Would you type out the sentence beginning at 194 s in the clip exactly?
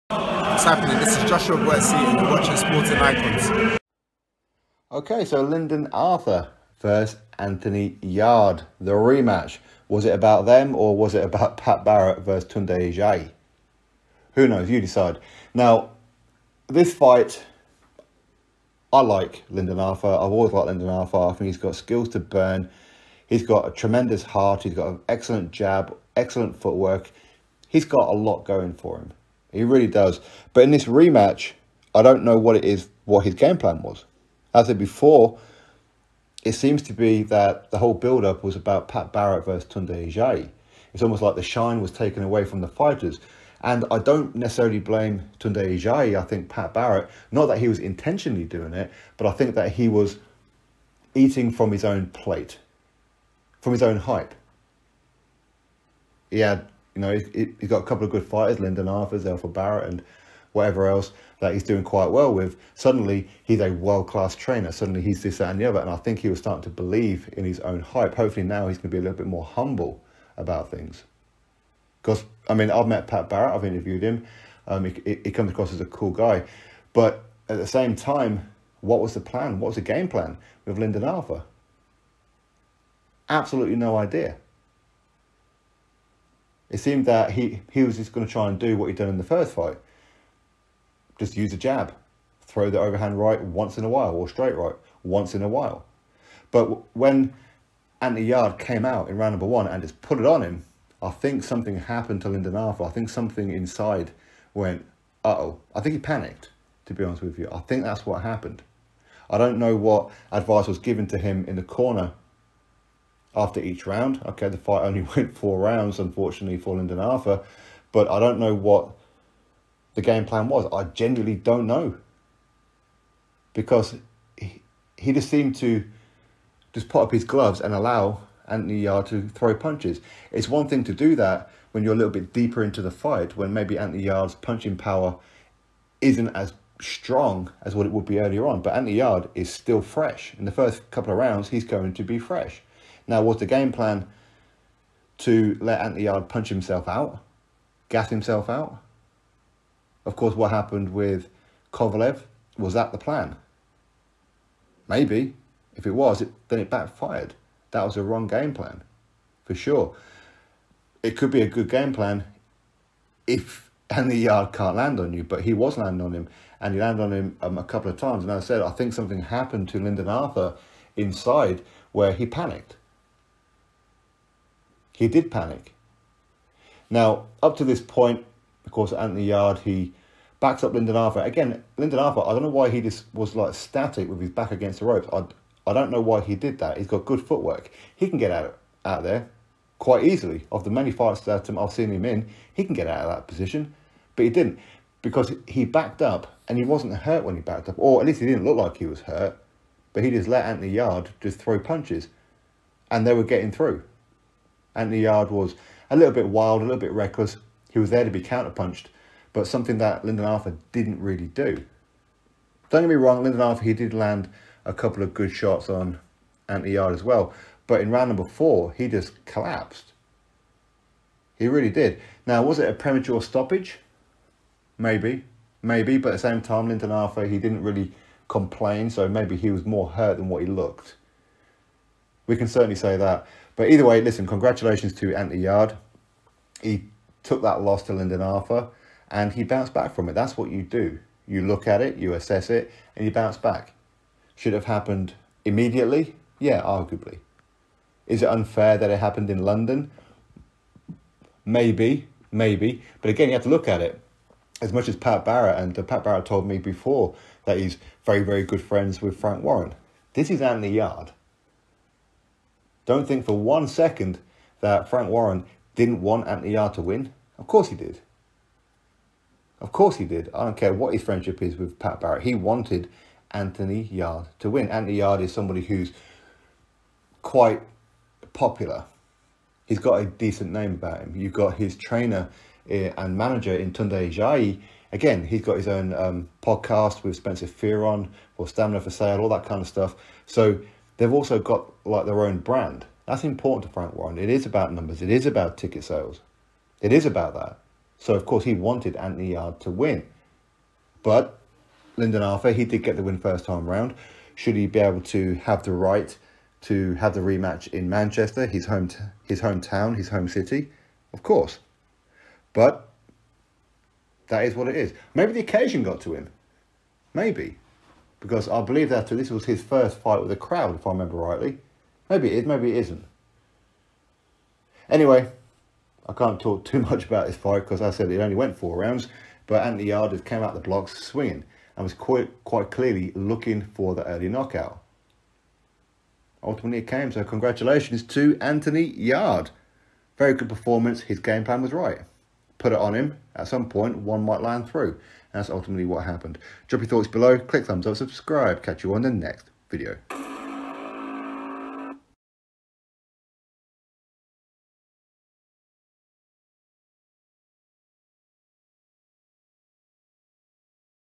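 But he didn't because he backed up and he wasn't hurt when he backed up.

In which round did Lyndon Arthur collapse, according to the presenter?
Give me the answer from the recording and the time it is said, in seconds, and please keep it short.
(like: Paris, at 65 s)
4, at 217 s.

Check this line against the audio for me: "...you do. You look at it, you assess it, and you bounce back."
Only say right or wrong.
right.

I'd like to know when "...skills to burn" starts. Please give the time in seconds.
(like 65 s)
21 s.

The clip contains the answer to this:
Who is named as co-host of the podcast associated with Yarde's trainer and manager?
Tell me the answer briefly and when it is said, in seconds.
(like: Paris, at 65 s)
Spencer Fearon, at 287 s.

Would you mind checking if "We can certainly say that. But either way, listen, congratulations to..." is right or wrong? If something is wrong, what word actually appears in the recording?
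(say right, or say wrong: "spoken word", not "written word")
right.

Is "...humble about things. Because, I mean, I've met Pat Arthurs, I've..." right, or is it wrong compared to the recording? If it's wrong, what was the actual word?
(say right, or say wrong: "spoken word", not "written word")
wrong: "Barrett", not "Arthurs".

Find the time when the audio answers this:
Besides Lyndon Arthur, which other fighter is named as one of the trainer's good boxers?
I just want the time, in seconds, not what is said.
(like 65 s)
59 s.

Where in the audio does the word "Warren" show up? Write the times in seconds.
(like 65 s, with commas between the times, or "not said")
259 s, 265 s, 293 s.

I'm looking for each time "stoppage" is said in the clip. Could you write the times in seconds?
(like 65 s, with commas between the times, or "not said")
223 s.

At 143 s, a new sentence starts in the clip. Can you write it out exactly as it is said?
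Now, was the game plan to let Anthony Yarde punch himself out, gas himself out?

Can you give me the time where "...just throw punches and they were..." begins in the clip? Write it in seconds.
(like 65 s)
201 s.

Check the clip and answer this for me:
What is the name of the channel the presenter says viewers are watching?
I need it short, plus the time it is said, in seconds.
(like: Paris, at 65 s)
Sporting Icons, at 2 s.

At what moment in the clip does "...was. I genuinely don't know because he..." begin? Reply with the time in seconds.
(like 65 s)
120 s.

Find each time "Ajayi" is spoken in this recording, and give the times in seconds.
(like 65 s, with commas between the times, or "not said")
12 s, 40 s, 45 s.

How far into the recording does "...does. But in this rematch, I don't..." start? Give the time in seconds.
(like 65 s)
29 s.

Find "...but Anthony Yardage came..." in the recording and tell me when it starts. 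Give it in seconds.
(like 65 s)
329 s.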